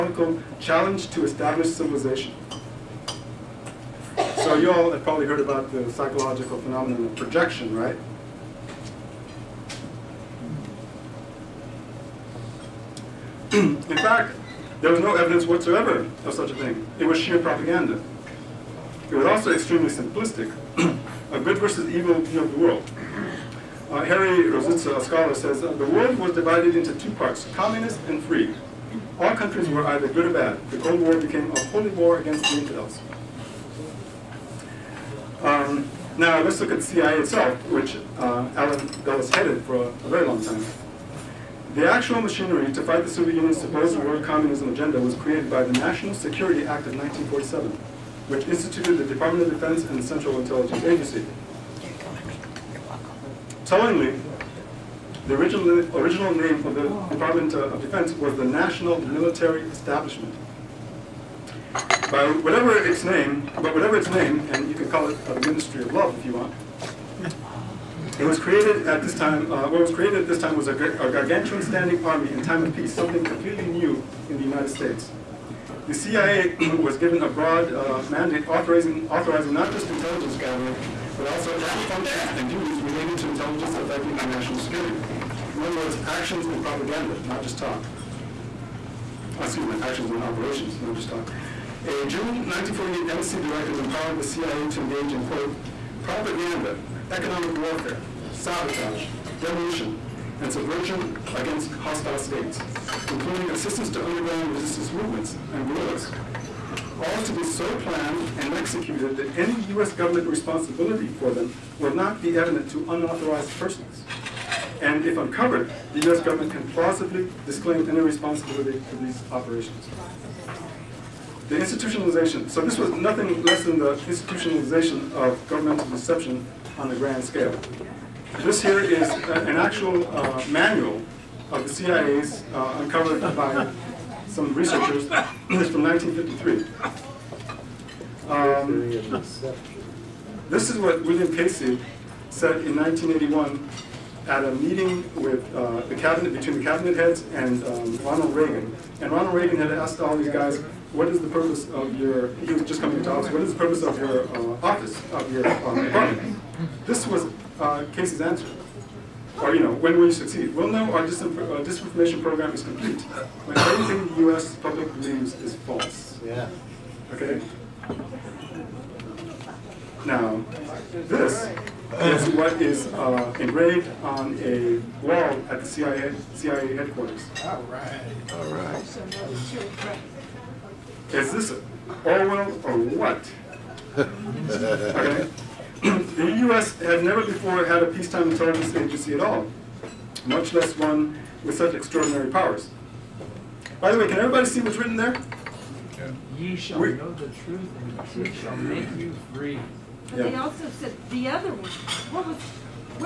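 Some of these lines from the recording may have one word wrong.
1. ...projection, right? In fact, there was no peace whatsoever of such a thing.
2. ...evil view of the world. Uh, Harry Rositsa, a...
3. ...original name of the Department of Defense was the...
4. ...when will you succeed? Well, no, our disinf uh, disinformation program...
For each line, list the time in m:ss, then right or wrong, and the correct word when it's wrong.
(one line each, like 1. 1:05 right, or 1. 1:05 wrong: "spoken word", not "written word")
1. 0:07 wrong: "evidence", not "peace"
2. 0:21 right
3. 0:55 right
4. 2:39 right.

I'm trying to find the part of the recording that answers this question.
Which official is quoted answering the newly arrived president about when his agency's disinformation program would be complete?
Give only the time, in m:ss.
2:21.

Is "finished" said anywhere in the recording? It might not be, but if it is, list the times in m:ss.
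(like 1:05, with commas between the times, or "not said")
not said.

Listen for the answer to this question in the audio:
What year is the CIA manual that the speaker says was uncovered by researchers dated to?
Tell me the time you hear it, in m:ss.
2:15.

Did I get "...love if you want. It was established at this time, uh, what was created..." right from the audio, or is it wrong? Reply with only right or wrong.
wrong.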